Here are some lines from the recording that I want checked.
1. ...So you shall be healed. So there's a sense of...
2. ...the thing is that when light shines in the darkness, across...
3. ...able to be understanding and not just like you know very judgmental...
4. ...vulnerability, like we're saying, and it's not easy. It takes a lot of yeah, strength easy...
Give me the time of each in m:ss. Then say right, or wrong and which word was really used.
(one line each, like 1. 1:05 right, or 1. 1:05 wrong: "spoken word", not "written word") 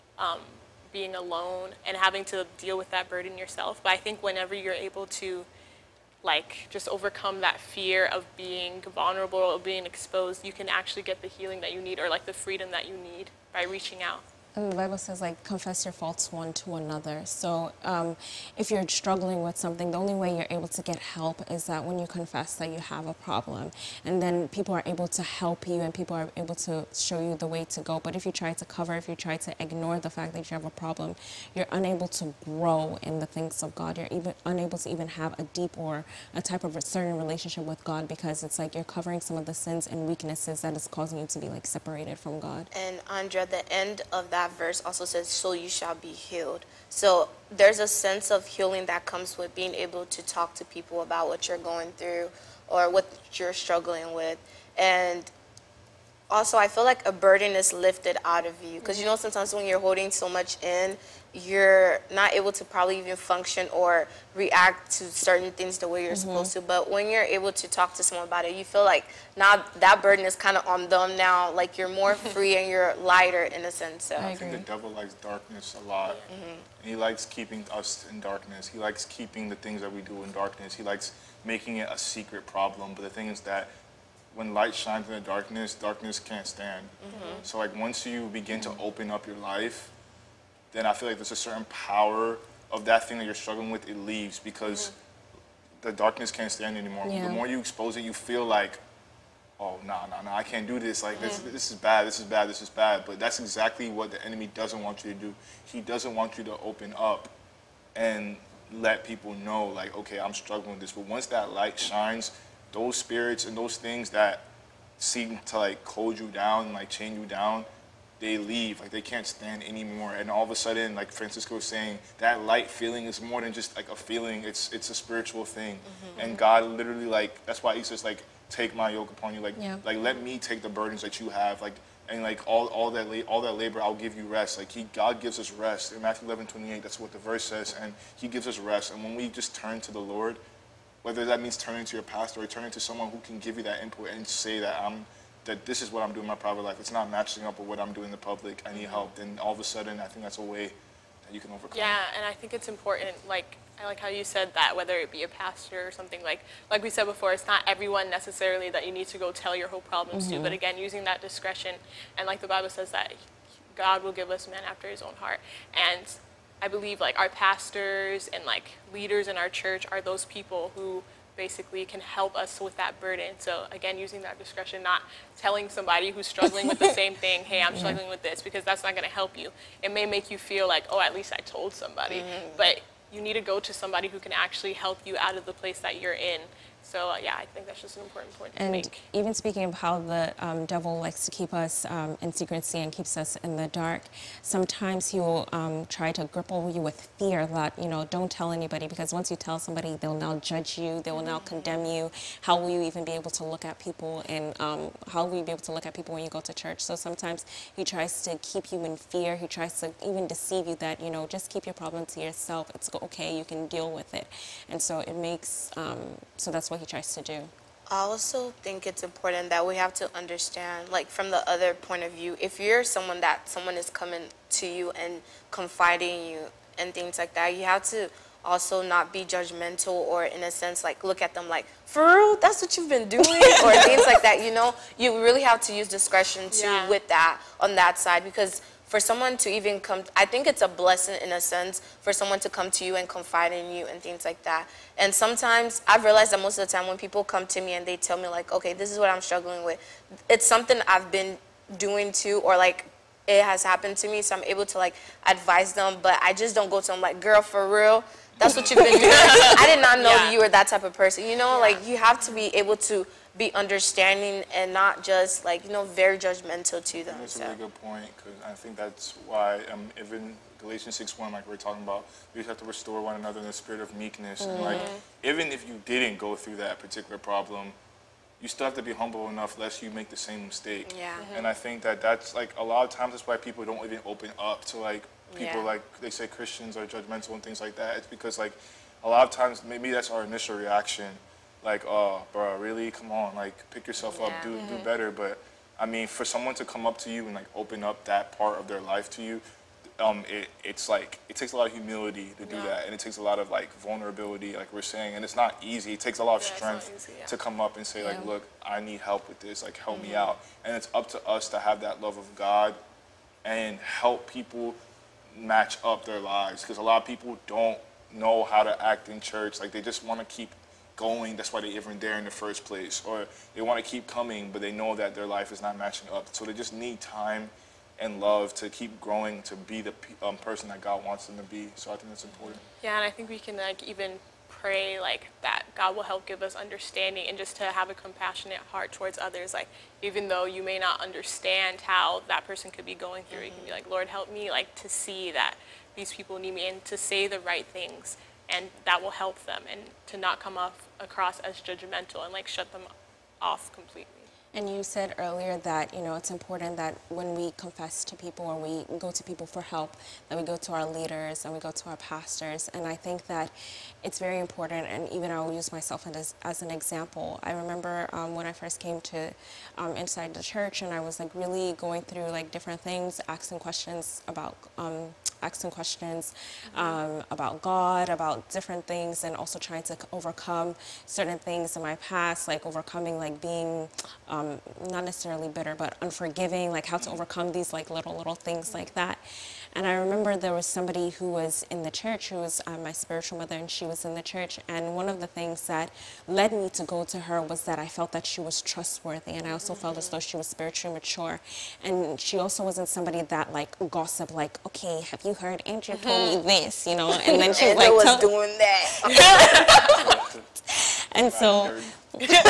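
1. 0:45 right
2. 1:23 wrong: "darkness", not "across"
3. 4:22 right
4. 5:03 right.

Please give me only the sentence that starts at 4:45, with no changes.
like they say Christians are judgmental and things like that.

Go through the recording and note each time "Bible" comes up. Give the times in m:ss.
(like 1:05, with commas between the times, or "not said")
0:14, 2:42.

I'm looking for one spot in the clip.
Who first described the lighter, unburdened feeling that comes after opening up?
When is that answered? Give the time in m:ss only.
2:01.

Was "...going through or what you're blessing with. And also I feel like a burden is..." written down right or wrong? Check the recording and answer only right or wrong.
wrong.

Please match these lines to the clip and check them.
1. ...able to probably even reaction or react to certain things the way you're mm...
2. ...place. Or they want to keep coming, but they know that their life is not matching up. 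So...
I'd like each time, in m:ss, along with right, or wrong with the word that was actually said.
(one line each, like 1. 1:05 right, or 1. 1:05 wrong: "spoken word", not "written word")
1. 1:02 wrong: "function", not "reaction"
2. 5:22 right.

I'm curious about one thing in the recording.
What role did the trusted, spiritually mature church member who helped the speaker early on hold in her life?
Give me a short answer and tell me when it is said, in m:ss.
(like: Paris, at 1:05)
Spiritual mother, at 6:32.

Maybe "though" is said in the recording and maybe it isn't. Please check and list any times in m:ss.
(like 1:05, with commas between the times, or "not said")
5:40, 6:40.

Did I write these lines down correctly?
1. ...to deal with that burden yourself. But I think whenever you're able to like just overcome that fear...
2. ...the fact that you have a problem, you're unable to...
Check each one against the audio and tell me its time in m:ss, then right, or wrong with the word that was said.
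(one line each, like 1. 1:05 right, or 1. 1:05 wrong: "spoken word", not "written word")
1. 0:02 right
2. 0:29 right.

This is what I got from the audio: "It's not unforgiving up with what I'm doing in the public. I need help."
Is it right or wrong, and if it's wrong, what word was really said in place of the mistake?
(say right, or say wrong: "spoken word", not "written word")
wrong: "matching", not "unforgiving".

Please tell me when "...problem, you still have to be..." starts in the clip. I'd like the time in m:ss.
4:37.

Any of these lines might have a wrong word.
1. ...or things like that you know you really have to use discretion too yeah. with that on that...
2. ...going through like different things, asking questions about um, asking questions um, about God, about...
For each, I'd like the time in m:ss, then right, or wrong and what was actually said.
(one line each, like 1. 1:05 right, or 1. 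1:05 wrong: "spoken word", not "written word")
1. 3:53 right
2. 6:11 right.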